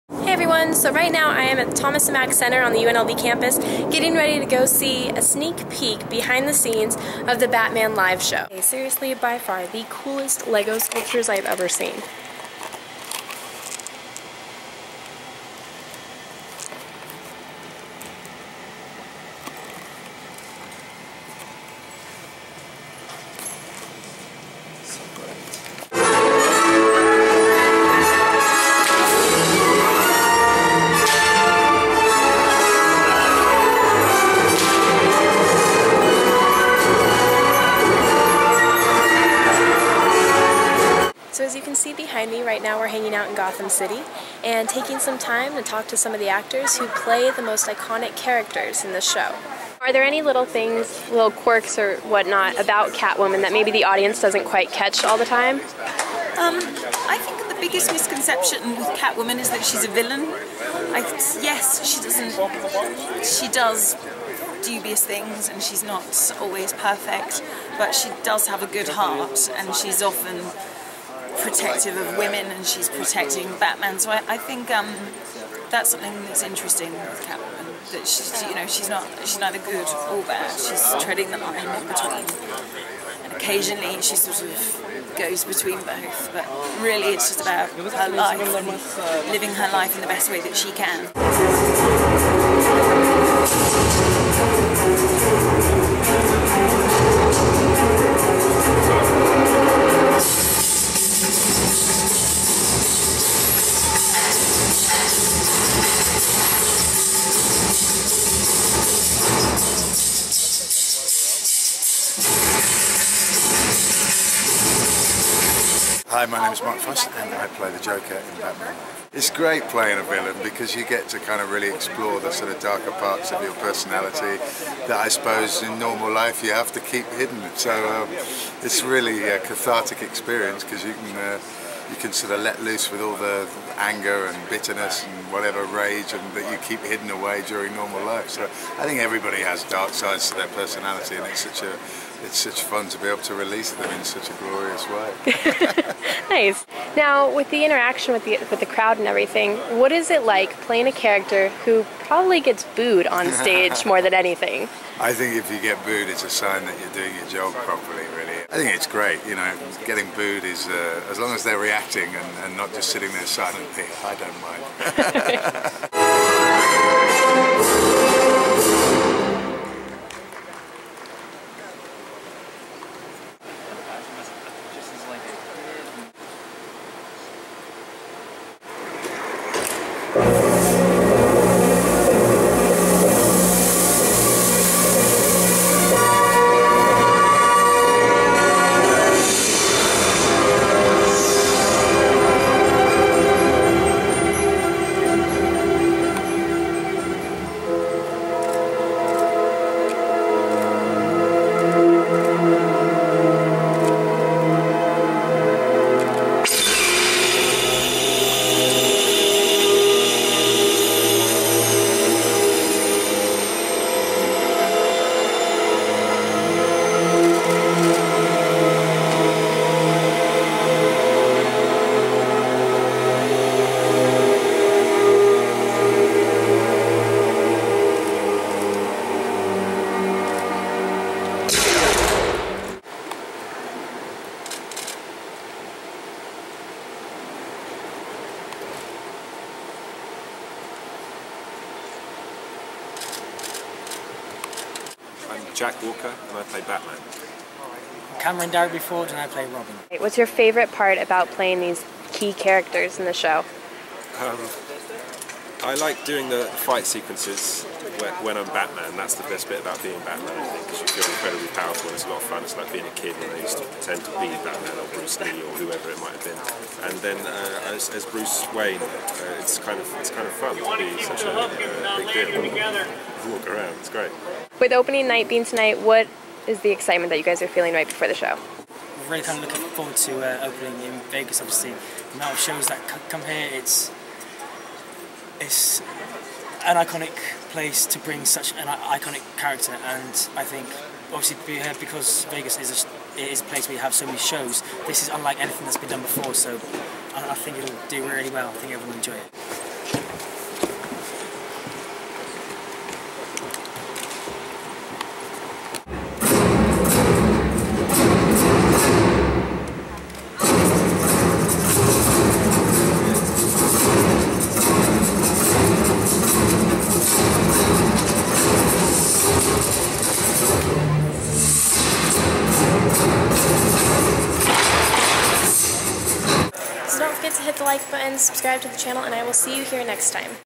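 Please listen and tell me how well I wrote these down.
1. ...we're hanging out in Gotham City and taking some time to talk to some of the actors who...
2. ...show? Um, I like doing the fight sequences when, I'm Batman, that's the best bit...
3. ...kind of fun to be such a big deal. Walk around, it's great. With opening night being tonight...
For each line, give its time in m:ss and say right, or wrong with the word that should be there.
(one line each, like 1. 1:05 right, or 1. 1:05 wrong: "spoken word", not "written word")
1. 0:42 right
2. 4:13 right
3. 4:30 right.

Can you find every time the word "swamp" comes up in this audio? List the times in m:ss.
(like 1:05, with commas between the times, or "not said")
not said.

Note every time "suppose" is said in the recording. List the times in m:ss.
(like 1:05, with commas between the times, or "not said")
2:05.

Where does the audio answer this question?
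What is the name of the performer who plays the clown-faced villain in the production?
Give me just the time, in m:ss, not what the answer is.
1:56.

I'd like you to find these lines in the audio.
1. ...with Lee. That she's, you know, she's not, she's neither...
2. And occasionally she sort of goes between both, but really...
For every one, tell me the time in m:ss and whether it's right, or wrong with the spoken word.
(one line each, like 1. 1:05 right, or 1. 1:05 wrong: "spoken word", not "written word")
1. 1:16 wrong: "Catwoman", not "Lee"
2. 1:23 right.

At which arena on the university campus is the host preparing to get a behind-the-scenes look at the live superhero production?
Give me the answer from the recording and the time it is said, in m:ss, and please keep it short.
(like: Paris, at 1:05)
Thomas and Mack Center, at 0:01.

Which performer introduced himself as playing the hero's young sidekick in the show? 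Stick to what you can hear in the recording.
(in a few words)
Kamran Darabi-Ford.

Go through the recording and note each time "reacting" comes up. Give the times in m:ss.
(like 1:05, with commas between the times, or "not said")
2:41.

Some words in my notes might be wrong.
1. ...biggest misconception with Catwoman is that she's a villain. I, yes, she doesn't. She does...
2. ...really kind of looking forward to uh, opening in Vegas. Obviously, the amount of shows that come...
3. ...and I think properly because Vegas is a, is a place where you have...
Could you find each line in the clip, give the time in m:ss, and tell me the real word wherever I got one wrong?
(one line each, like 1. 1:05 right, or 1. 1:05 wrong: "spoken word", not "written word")
1. 0:57 right
2. 4:39 right
3. 4:49 wrong: "obviously", not "properly".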